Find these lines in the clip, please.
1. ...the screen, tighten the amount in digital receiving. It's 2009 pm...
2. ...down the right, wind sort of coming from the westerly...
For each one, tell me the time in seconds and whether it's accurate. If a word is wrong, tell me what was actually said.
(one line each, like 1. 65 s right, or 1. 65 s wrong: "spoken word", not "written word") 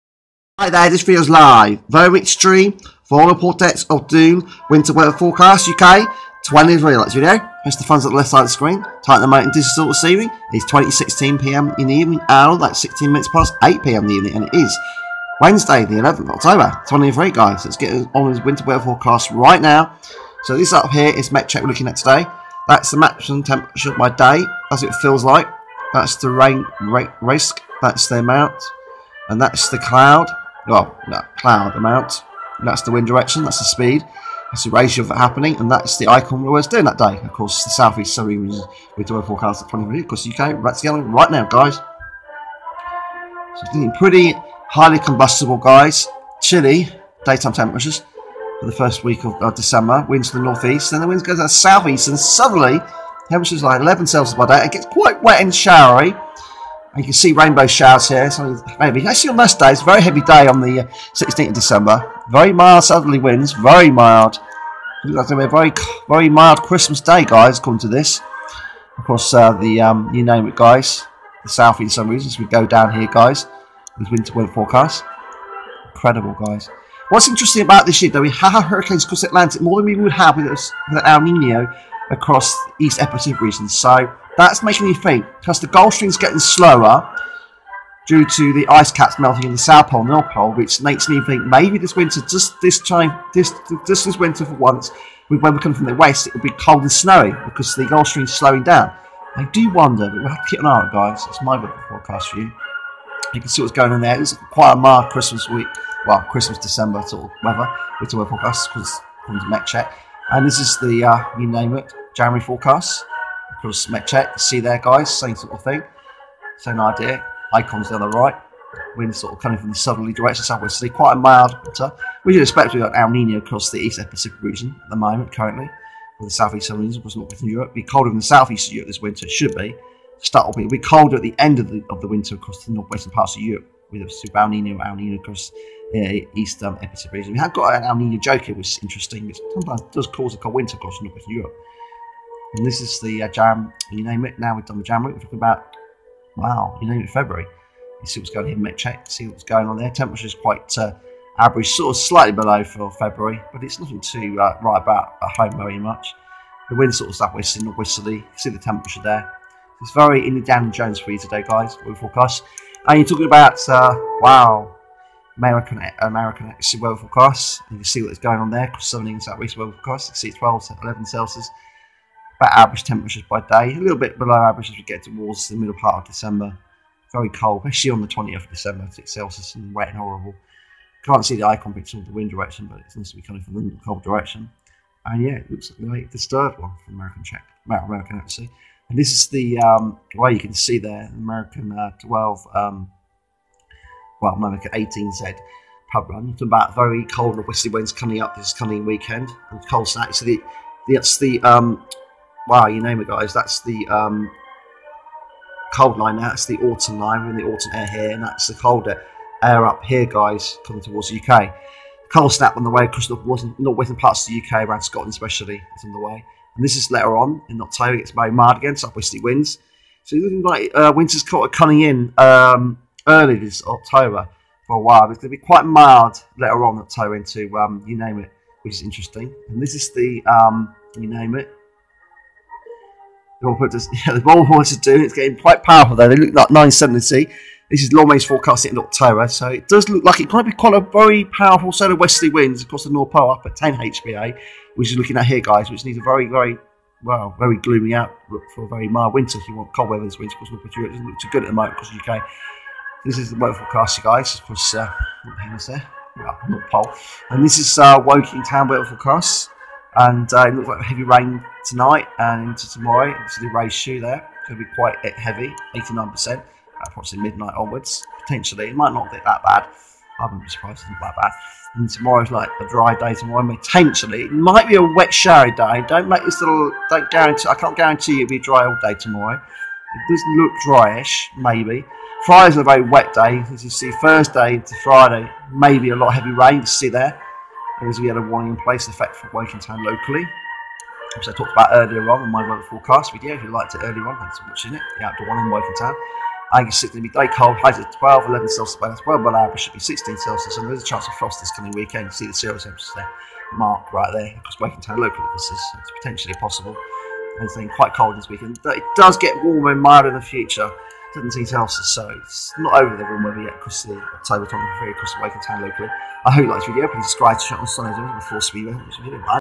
1. 8 s wrong: "2016", not "2009"
2. 117 s wrong: "southerly", not "westerly".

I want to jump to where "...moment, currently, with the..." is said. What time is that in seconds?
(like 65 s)
124 s.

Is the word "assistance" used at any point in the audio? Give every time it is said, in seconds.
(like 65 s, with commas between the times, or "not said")
not said.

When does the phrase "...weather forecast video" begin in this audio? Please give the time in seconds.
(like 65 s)
292 s.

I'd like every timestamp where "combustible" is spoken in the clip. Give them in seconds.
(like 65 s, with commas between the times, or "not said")
44 s.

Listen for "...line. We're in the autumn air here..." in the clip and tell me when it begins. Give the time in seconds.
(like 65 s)
206 s.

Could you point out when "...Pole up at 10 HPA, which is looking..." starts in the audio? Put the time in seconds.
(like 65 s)
243 s.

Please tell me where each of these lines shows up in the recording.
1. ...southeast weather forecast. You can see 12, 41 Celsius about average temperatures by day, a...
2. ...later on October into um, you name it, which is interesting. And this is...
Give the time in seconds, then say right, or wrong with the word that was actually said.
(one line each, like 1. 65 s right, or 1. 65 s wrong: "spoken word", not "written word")
1. 169 s wrong: "11", not "41"
2. 226 s right.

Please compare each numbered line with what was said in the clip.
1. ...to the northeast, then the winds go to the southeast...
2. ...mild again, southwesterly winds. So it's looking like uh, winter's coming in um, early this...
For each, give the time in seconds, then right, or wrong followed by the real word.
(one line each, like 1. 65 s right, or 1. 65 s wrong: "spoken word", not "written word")
1. 50 s right
2. 218 s right.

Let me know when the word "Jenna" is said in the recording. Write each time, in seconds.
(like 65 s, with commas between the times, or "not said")
not said.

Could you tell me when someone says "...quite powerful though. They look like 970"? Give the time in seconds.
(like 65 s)
235 s.